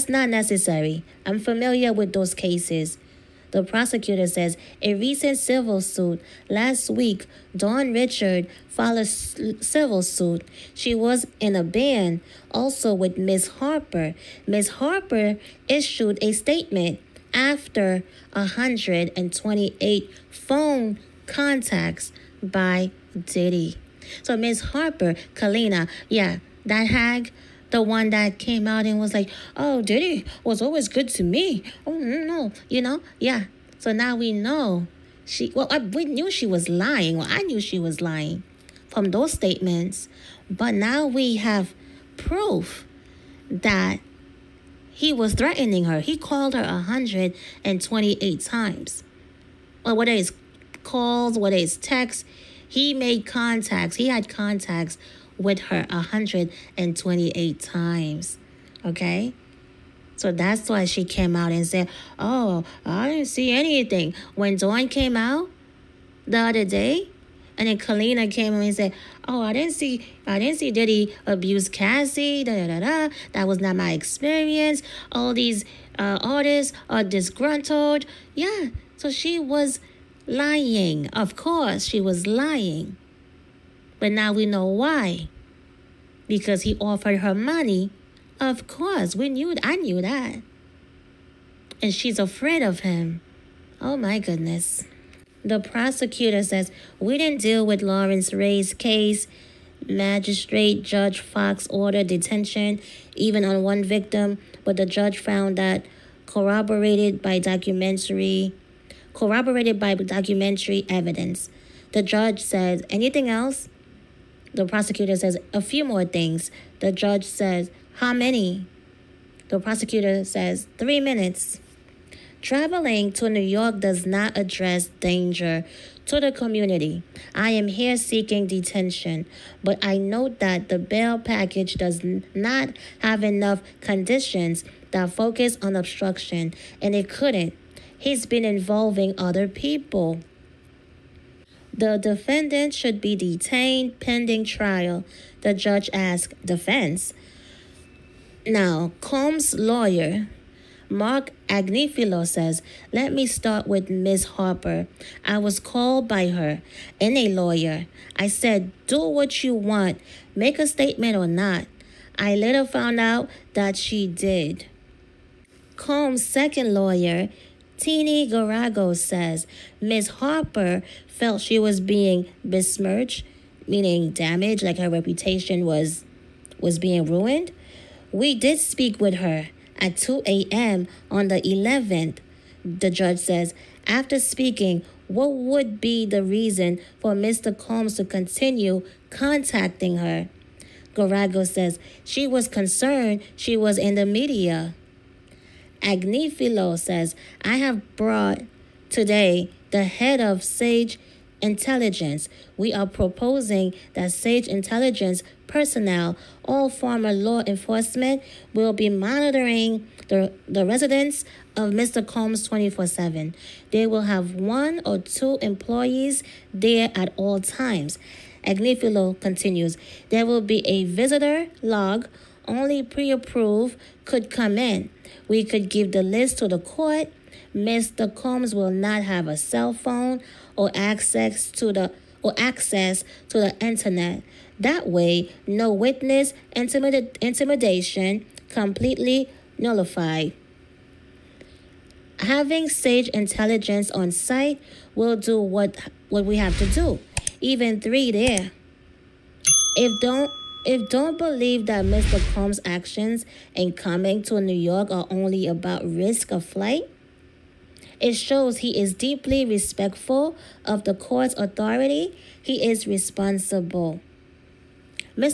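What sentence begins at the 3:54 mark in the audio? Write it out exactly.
That way, no witness intimidation completely nullified.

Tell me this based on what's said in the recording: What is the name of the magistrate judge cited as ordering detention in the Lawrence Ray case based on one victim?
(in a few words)
Fox.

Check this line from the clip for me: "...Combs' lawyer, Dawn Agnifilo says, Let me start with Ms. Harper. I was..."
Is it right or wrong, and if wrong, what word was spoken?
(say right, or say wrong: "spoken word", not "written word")
wrong: "Marc", not "Dawn".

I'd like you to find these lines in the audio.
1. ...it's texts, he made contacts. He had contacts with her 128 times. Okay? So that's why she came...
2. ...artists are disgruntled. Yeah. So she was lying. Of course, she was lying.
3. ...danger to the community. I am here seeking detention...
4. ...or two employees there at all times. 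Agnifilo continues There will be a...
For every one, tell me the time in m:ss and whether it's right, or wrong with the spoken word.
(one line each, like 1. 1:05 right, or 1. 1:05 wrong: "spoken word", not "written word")
1. 0:51 right
2. 1:16 right
3. 2:05 right
4. 3:34 right.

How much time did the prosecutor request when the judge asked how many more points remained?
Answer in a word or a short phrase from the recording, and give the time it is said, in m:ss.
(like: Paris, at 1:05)
3 minutes, at 2:00.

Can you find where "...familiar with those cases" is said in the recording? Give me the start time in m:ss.
0:01.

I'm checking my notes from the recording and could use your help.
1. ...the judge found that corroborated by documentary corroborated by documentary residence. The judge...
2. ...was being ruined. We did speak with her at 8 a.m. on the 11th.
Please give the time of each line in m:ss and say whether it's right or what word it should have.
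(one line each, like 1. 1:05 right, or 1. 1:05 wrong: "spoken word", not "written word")
1. 1:44 wrong: "evidence", not "residence"
2. 2:56 wrong: "2", not "8".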